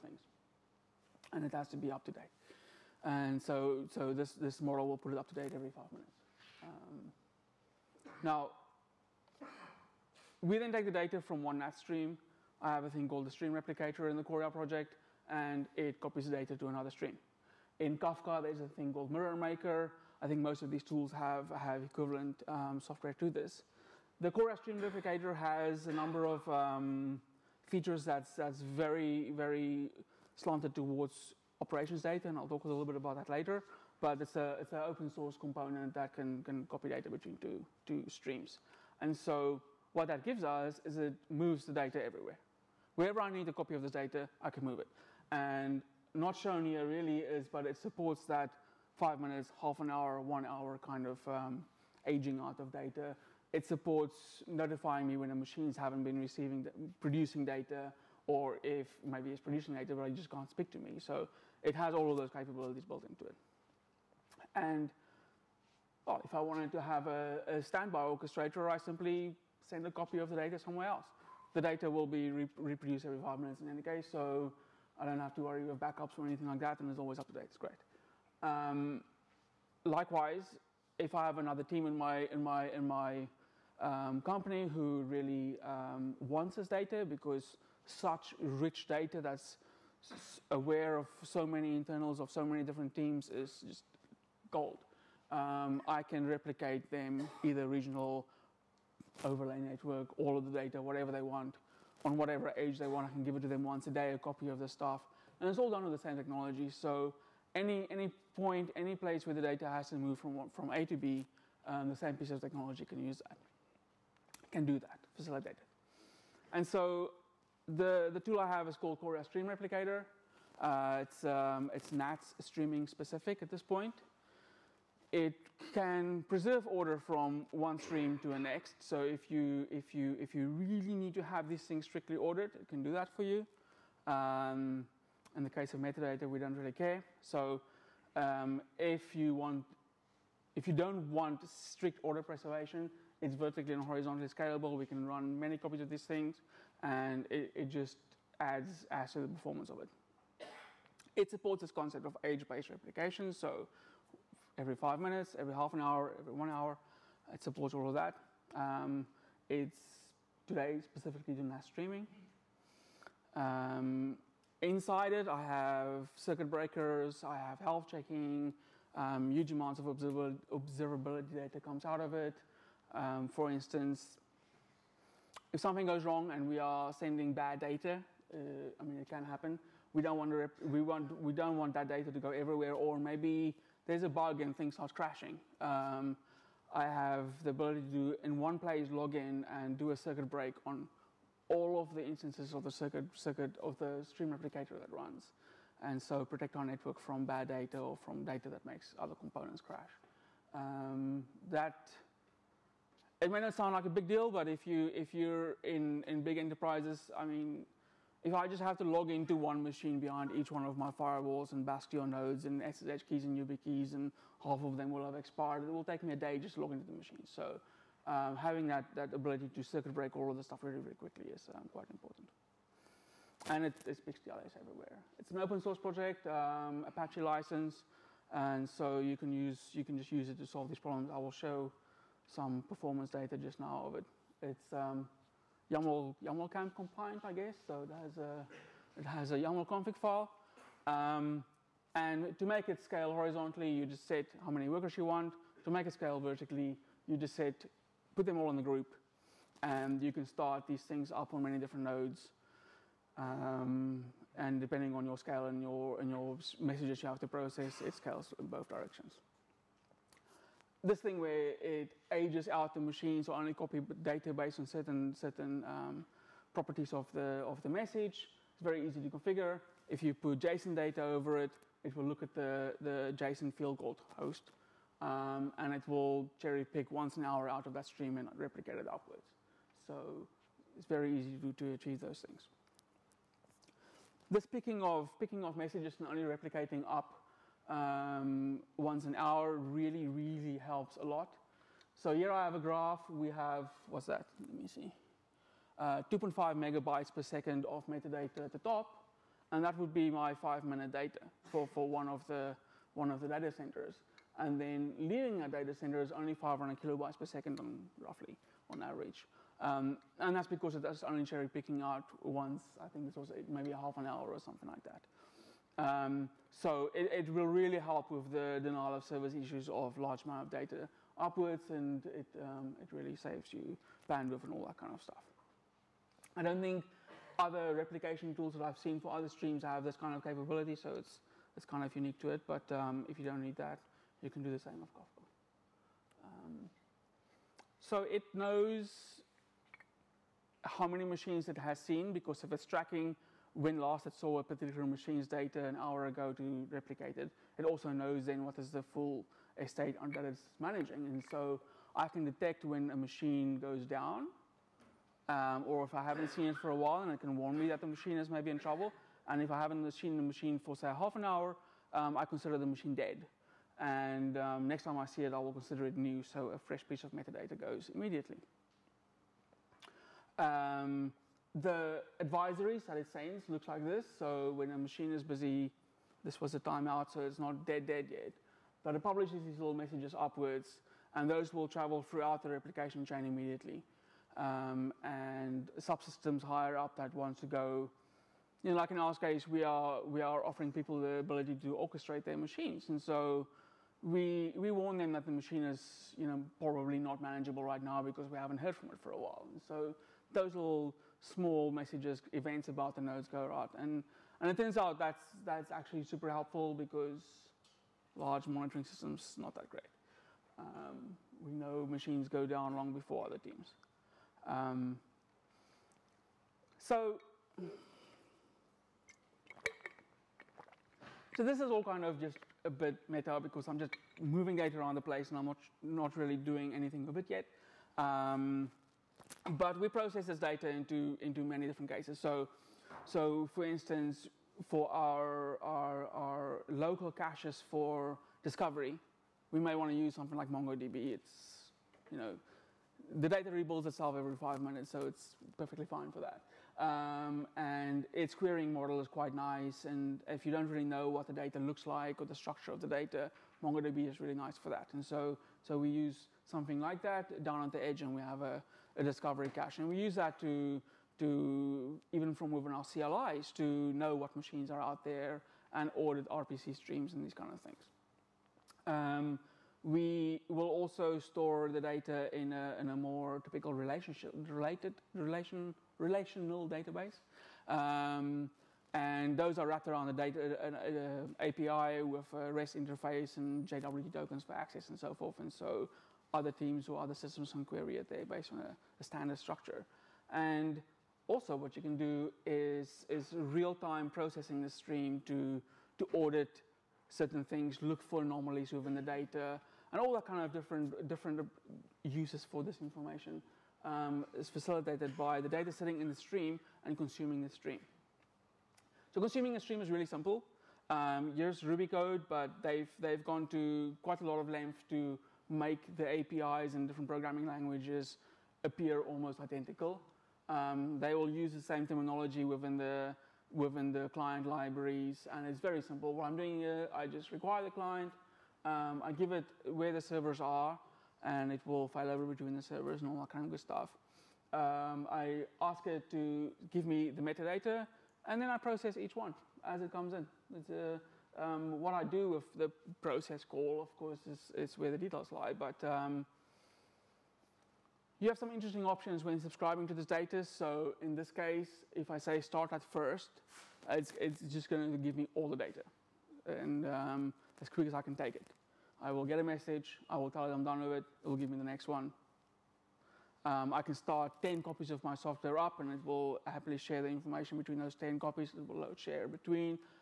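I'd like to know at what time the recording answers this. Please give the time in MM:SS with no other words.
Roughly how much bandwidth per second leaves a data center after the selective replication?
05:06.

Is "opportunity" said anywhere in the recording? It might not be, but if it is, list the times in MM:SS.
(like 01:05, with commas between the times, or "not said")
not said.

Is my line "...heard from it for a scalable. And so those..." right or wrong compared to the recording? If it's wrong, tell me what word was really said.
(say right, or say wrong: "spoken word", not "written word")
wrong: "while", not "scalable".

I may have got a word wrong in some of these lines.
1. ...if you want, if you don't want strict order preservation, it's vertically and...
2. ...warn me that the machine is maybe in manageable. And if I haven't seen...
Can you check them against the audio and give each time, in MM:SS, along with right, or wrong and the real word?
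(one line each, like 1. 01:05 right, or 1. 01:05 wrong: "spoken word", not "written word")
1. 02:18 right
2. 05:57 wrong: "trouble", not "manageable".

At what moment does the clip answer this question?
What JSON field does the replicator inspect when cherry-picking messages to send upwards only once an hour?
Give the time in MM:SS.
04:33.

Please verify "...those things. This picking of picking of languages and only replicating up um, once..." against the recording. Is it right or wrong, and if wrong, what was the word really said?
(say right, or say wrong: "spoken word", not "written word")
wrong: "messages", not "languages".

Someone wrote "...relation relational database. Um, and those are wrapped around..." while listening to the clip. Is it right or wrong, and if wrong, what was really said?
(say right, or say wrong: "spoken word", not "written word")
right.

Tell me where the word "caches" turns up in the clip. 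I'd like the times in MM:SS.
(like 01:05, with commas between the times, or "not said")
07:17, 07:39.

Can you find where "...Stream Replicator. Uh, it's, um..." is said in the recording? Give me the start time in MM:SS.
01:59.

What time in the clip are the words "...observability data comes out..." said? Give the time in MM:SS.
02:49.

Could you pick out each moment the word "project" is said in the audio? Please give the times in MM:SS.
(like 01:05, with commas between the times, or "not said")
00:14, 03:45.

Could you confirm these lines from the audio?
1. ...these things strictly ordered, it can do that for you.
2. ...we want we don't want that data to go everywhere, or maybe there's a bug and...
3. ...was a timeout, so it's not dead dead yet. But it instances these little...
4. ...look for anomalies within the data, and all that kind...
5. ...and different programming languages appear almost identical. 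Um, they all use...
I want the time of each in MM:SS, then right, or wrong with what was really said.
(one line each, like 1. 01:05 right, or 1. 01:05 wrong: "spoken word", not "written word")
1. 02:11 right
2. 03:00 right
3. 06:16 wrong: "publishes", not "instances"
4. 08:17 right
5. 08:36 right.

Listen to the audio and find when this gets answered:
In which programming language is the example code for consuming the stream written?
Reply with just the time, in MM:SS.
08:31.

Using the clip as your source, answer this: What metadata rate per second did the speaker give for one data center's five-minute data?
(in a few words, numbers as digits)
2.5 megabytes per second.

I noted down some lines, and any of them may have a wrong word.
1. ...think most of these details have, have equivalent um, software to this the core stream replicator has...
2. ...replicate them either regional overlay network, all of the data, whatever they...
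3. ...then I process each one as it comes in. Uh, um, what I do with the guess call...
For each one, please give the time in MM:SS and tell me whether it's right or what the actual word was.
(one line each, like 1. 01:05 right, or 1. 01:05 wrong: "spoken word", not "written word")
1. 00:20 wrong: "tools", not "details"
2. 01:36 right
3. 08:58 wrong: "process", not "guess".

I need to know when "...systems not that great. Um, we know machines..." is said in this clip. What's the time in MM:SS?
06:48.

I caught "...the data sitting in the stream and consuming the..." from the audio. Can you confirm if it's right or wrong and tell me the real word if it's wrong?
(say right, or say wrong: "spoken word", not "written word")
right.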